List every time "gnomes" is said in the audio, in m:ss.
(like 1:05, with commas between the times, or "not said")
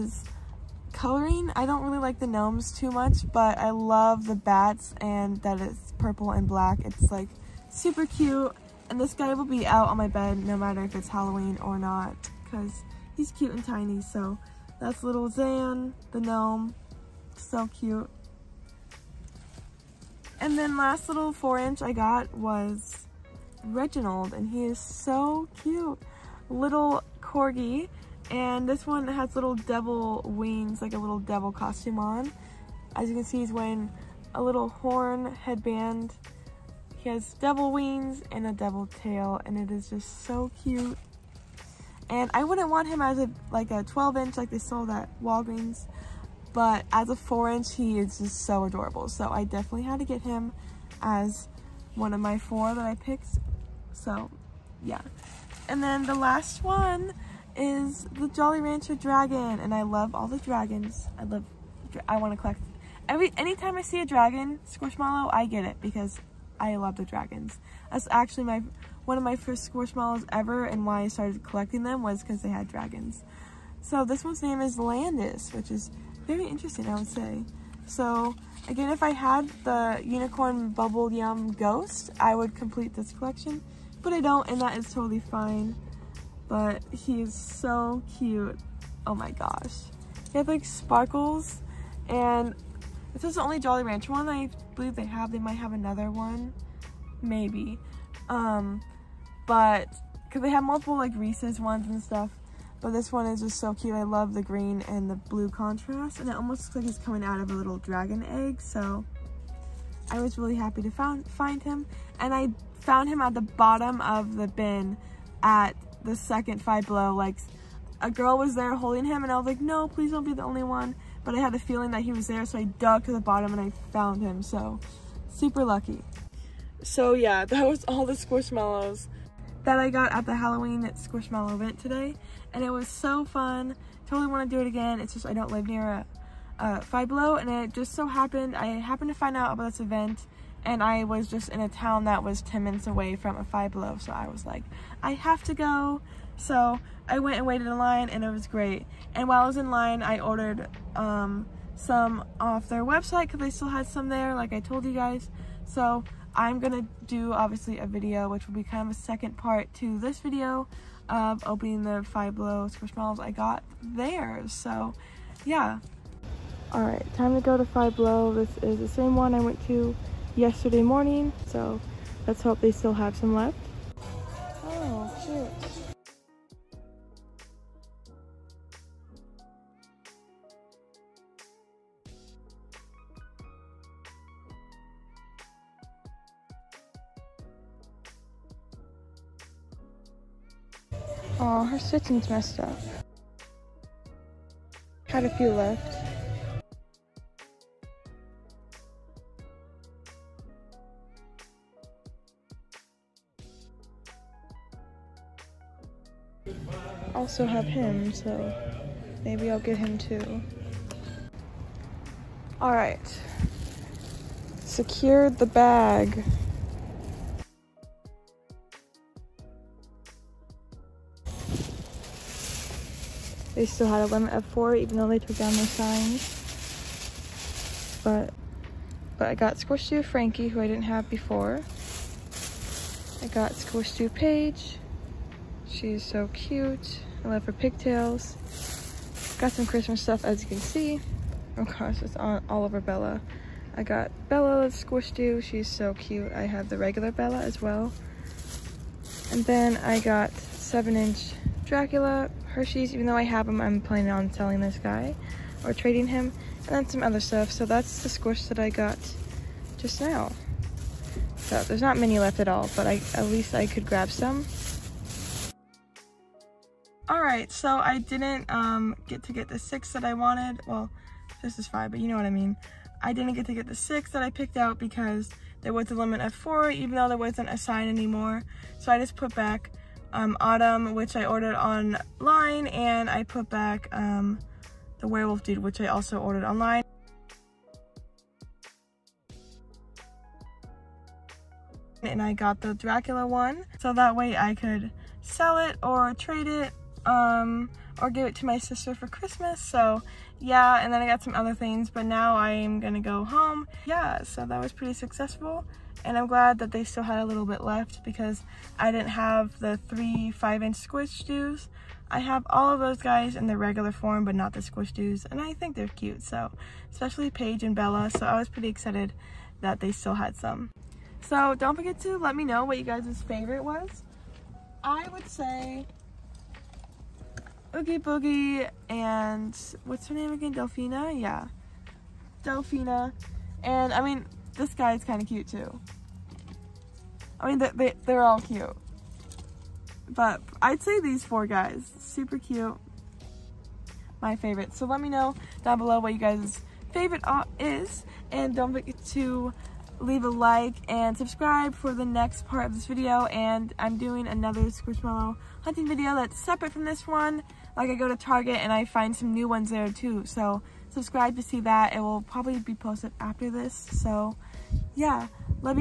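0:02, 0:16.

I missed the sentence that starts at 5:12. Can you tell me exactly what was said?
I have all of those guys in the regular form, but not the squishdoos.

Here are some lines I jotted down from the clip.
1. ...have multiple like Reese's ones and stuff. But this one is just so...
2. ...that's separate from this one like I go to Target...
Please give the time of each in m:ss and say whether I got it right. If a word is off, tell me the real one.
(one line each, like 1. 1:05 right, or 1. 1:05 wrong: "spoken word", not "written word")
1. 1:40 right
2. 5:56 right.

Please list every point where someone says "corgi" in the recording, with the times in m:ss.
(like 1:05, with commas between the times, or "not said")
0:27.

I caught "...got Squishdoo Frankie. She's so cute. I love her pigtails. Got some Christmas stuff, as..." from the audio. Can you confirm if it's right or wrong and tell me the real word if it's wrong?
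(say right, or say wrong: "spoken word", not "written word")
wrong: "Paige", not "Frankie".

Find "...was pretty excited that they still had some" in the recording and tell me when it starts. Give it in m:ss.
5:18.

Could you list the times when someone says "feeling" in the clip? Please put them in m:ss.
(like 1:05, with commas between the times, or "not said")
2:01.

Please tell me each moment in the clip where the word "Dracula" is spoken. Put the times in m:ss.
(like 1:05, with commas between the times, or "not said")
4:11, 4:52.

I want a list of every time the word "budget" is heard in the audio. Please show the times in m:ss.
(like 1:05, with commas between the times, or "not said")
not said.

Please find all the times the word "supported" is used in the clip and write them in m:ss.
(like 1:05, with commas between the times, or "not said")
not said.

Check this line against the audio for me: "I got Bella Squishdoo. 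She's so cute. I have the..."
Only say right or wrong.
right.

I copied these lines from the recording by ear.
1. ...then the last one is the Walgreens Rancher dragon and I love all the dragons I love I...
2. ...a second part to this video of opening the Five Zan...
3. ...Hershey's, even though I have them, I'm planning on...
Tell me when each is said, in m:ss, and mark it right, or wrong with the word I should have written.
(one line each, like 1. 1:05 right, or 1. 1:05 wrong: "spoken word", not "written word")
1. 0:55 wrong: "Jolly", not "Walgreens"
2. 2:38 wrong: "Below", not "Zan"
3. 4:12 right.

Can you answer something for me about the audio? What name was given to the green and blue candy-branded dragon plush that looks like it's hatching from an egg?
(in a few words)
Landis.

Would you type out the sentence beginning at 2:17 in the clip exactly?
And it just so happened, I happened to find out about this event.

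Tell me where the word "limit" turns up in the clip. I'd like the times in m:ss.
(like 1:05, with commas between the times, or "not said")
3:44, 4:35.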